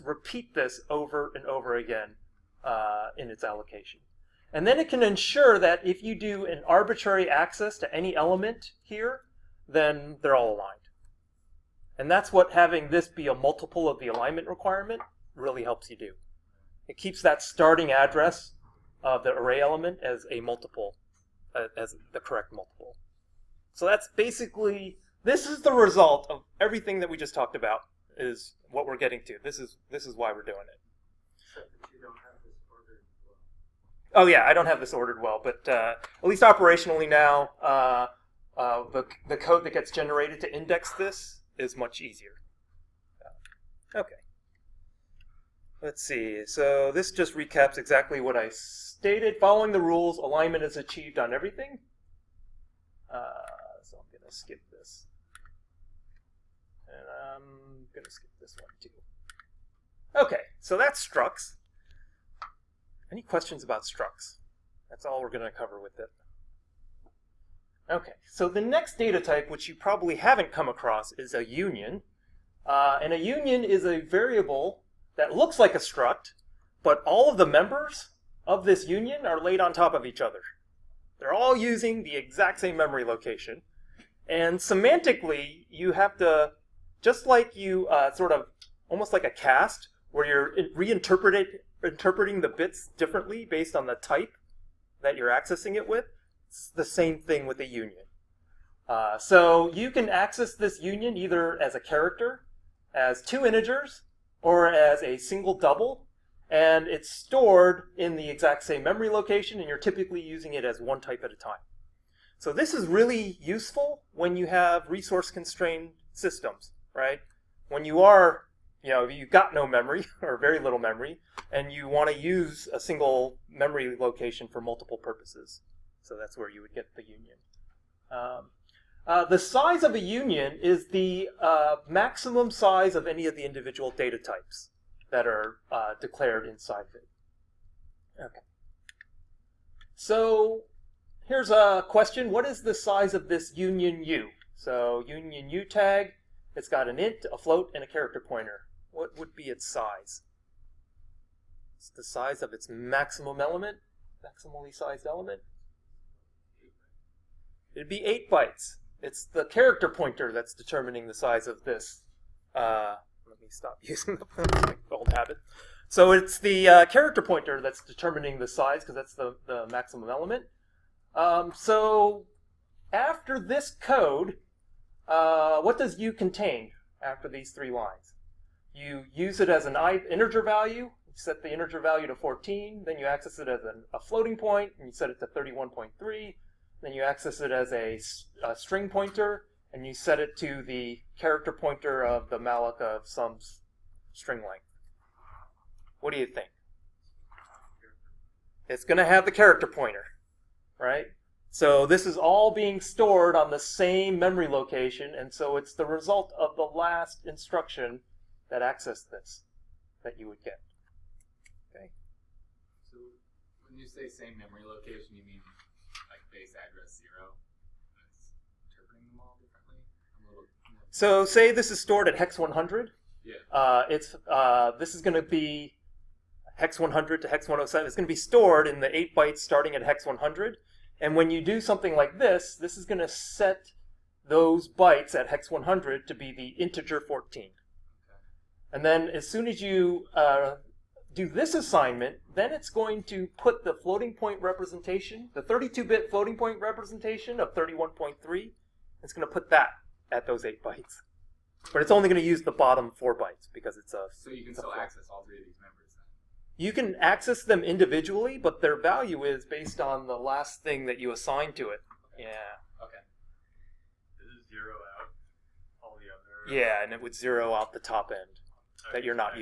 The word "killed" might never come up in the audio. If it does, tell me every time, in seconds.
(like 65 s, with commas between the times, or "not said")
not said.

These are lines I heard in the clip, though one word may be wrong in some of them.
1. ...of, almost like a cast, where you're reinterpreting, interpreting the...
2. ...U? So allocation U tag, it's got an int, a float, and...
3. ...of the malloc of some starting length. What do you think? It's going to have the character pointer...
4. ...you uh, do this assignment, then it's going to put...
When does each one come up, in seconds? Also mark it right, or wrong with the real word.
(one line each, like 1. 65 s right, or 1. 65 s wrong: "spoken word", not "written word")
1. 88 s right
2. 144 s wrong: "union", not "allocation"
3. 192 s wrong: "string", not "starting"
4. 239 s right.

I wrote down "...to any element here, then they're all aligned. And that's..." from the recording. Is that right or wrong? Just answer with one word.
right.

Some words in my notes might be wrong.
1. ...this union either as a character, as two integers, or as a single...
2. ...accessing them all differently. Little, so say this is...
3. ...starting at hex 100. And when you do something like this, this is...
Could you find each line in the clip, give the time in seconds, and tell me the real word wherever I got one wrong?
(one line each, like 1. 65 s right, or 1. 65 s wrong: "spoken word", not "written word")
1. 100 s right
2. 218 s wrong: "interpreting", not "accessing"
3. 229 s right.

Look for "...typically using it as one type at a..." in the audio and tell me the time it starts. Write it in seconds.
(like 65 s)
109 s.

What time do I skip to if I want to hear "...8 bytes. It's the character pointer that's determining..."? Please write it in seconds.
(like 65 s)
158 s.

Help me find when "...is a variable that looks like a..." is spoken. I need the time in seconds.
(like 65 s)
73 s.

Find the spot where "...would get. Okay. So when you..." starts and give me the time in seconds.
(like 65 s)
210 s.